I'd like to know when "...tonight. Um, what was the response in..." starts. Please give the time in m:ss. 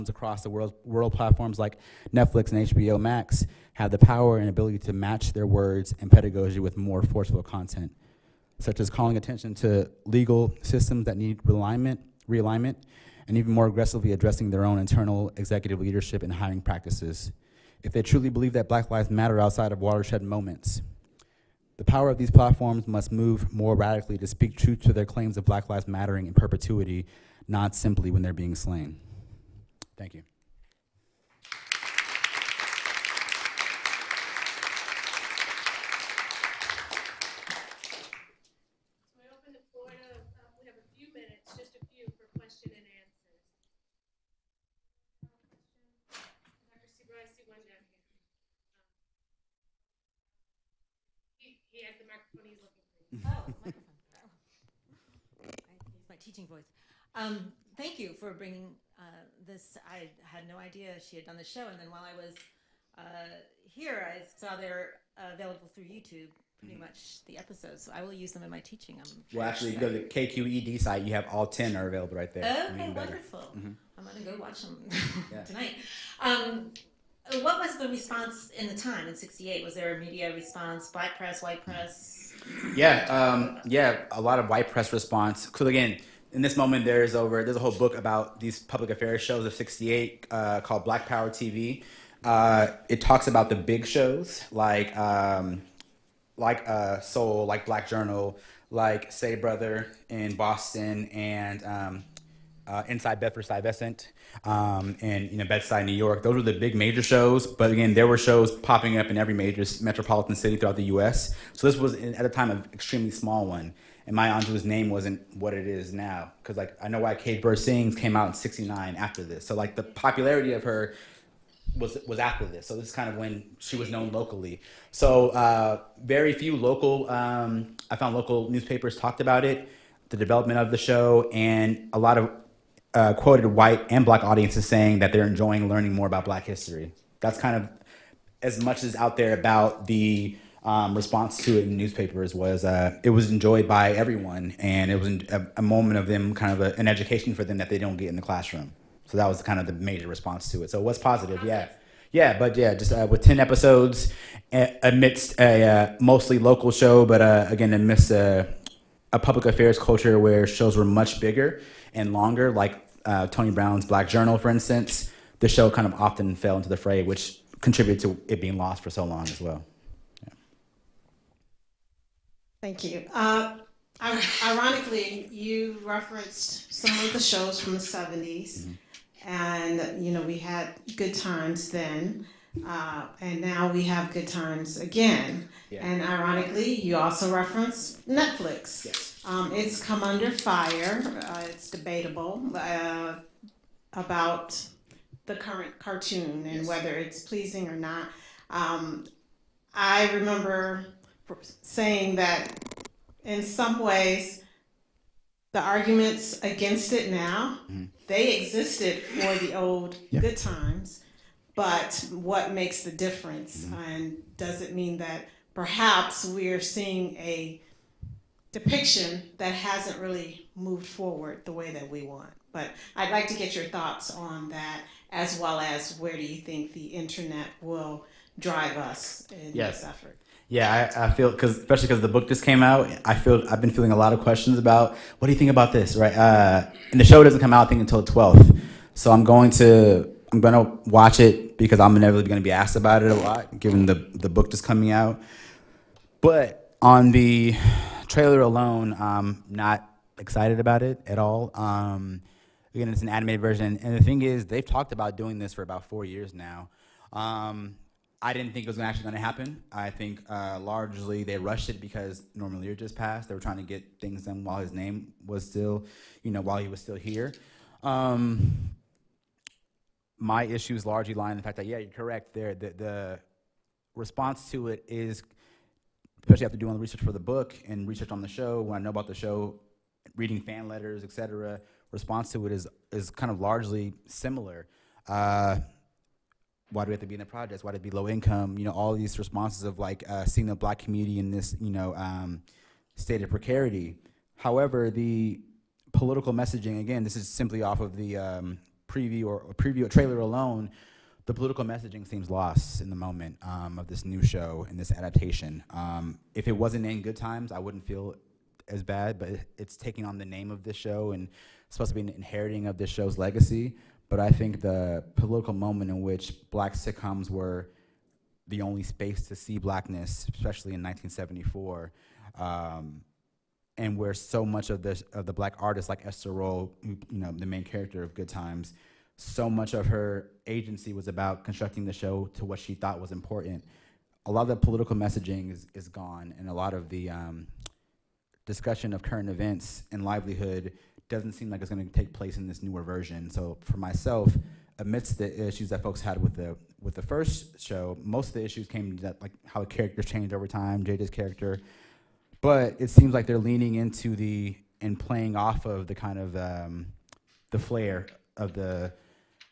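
1:15.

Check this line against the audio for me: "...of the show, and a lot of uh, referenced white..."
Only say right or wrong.
wrong.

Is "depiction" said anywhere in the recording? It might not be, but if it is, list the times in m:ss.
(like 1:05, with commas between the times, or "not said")
3:38.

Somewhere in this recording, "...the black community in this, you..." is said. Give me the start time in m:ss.
4:50.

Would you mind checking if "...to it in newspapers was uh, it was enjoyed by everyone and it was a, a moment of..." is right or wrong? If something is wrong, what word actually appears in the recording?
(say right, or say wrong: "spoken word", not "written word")
right.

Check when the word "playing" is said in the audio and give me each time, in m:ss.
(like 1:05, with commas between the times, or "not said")
5:54.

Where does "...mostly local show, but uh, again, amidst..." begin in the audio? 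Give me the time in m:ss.
2:36.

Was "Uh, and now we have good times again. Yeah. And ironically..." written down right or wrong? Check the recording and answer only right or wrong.
right.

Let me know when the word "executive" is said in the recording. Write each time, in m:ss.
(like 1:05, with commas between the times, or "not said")
0:15.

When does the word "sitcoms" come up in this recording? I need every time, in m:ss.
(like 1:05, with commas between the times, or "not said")
5:16.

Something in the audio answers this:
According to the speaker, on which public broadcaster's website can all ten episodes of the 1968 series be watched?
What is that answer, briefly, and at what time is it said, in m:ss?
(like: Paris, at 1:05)
KQED, at 1:10.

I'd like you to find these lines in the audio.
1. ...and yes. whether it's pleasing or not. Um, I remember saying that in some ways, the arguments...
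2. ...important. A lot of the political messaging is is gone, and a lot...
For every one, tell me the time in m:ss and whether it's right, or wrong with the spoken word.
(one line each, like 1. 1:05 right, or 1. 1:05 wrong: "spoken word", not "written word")
1. 3:16 right
2. 5:33 right.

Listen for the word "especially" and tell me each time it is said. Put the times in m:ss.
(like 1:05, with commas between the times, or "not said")
3:51, 4:36, 5:20.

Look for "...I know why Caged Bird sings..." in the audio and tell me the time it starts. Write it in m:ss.
1:56.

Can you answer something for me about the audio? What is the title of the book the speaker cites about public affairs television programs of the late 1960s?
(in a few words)
Black Power TV.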